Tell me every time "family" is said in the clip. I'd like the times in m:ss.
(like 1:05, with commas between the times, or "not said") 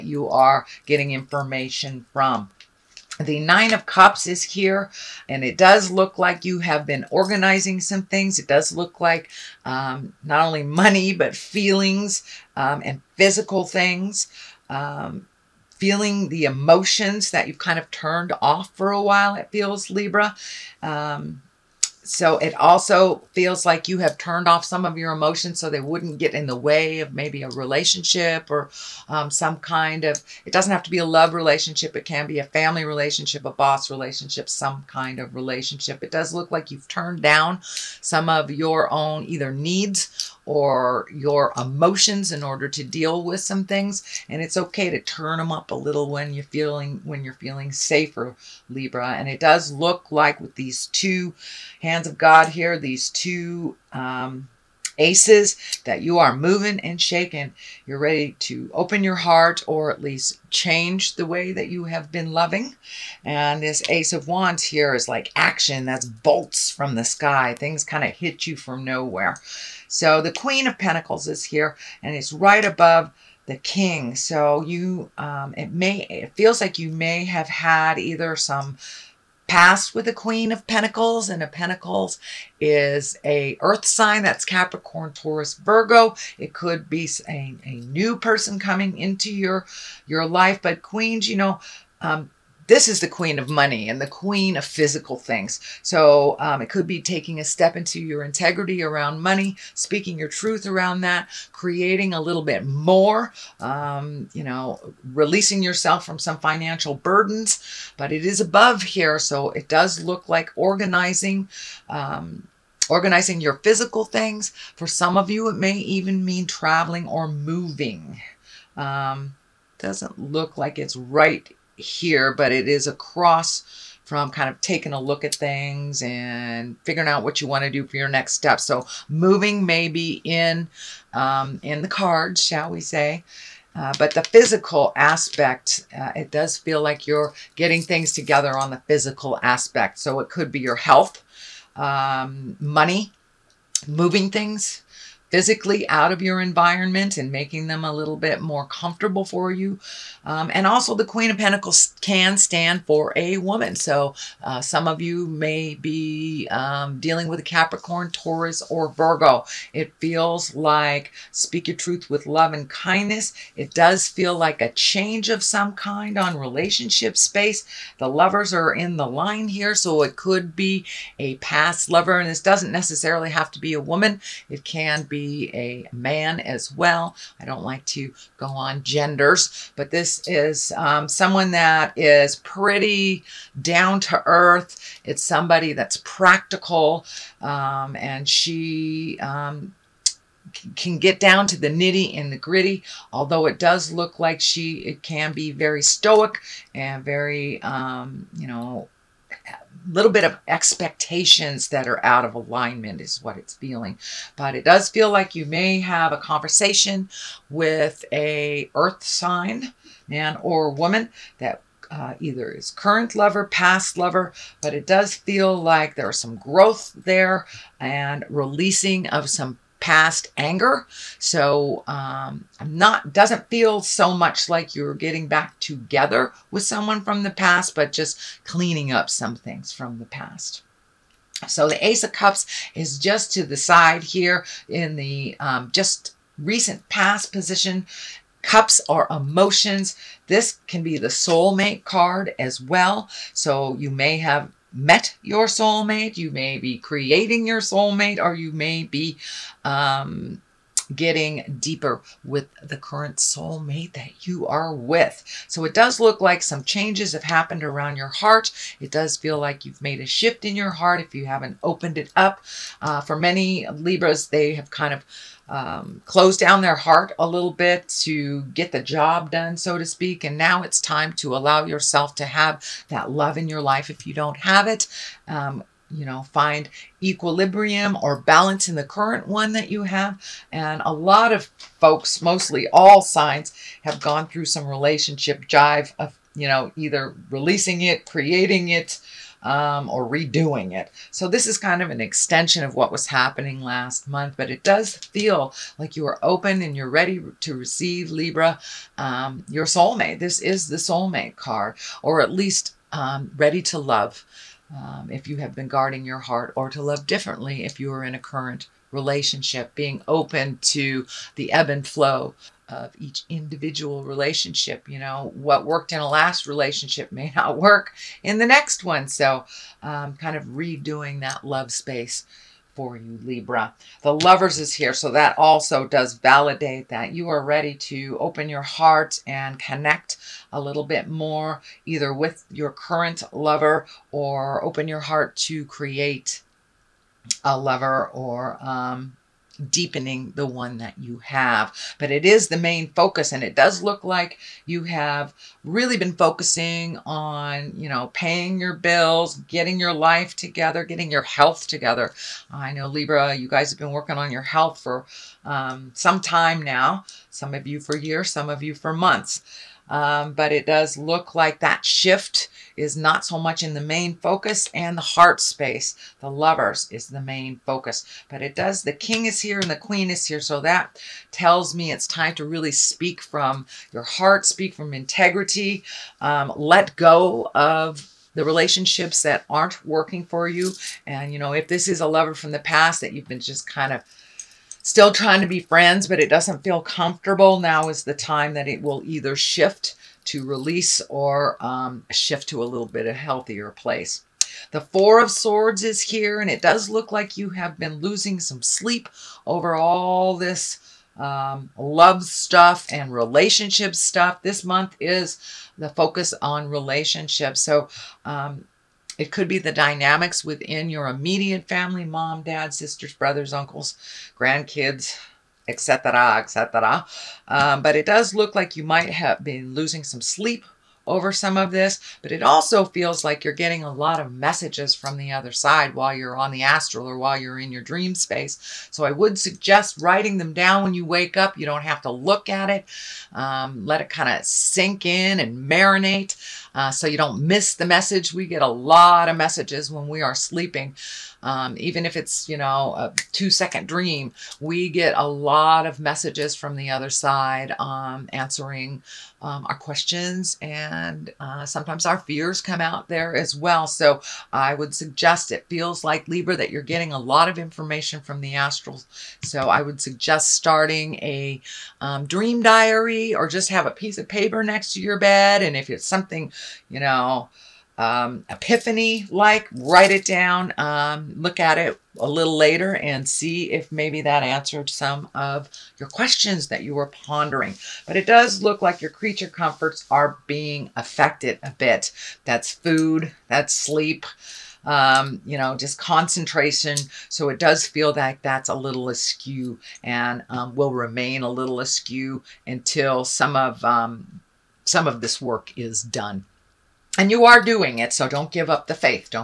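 0:32, 6:51.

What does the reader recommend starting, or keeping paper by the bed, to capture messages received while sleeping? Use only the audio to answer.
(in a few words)
dream diary.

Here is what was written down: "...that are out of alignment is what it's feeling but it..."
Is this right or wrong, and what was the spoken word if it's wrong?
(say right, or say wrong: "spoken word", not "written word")
right.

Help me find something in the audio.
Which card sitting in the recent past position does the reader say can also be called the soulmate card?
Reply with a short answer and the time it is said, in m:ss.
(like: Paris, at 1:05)
Ace of Cups, at 3:51.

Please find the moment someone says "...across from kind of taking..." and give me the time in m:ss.
2:02.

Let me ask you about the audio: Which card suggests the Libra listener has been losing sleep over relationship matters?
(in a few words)
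Four of Swords.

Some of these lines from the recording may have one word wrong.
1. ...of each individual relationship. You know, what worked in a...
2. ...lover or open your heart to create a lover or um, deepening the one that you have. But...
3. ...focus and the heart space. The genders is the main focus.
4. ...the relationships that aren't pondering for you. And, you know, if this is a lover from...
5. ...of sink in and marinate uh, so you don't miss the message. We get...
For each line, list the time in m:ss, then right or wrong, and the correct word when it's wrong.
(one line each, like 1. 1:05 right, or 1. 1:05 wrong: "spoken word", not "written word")
1. 5:12 right
2. 5:33 right
3. 6:04 wrong: "lovers", not "genders"
4. 6:18 wrong: "working", not "pondering"
5. 7:14 right.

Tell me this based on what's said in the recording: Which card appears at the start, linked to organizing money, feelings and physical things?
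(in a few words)
Nine of Cups.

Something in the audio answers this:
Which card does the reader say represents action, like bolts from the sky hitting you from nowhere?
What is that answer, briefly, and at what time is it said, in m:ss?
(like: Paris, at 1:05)
Ace of Wands, at 1:03.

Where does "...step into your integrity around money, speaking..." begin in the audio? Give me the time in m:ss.
1:37.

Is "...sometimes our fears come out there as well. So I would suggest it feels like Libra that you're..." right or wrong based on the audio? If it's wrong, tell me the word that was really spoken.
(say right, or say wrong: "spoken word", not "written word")
right.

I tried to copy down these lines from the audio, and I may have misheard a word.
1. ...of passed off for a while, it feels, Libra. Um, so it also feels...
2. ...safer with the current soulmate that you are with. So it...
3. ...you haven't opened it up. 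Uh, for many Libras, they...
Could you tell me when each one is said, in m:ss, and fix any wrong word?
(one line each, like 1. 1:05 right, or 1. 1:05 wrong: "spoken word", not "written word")
1. 0:17 wrong: "turned", not "passed"
2. 4:11 wrong: "deeper", not "safer"
3. 4:21 right.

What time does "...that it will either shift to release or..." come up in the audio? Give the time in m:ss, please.
6:28.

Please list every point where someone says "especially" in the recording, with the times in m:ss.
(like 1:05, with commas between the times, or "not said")
not said.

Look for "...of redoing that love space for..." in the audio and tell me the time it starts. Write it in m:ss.
5:20.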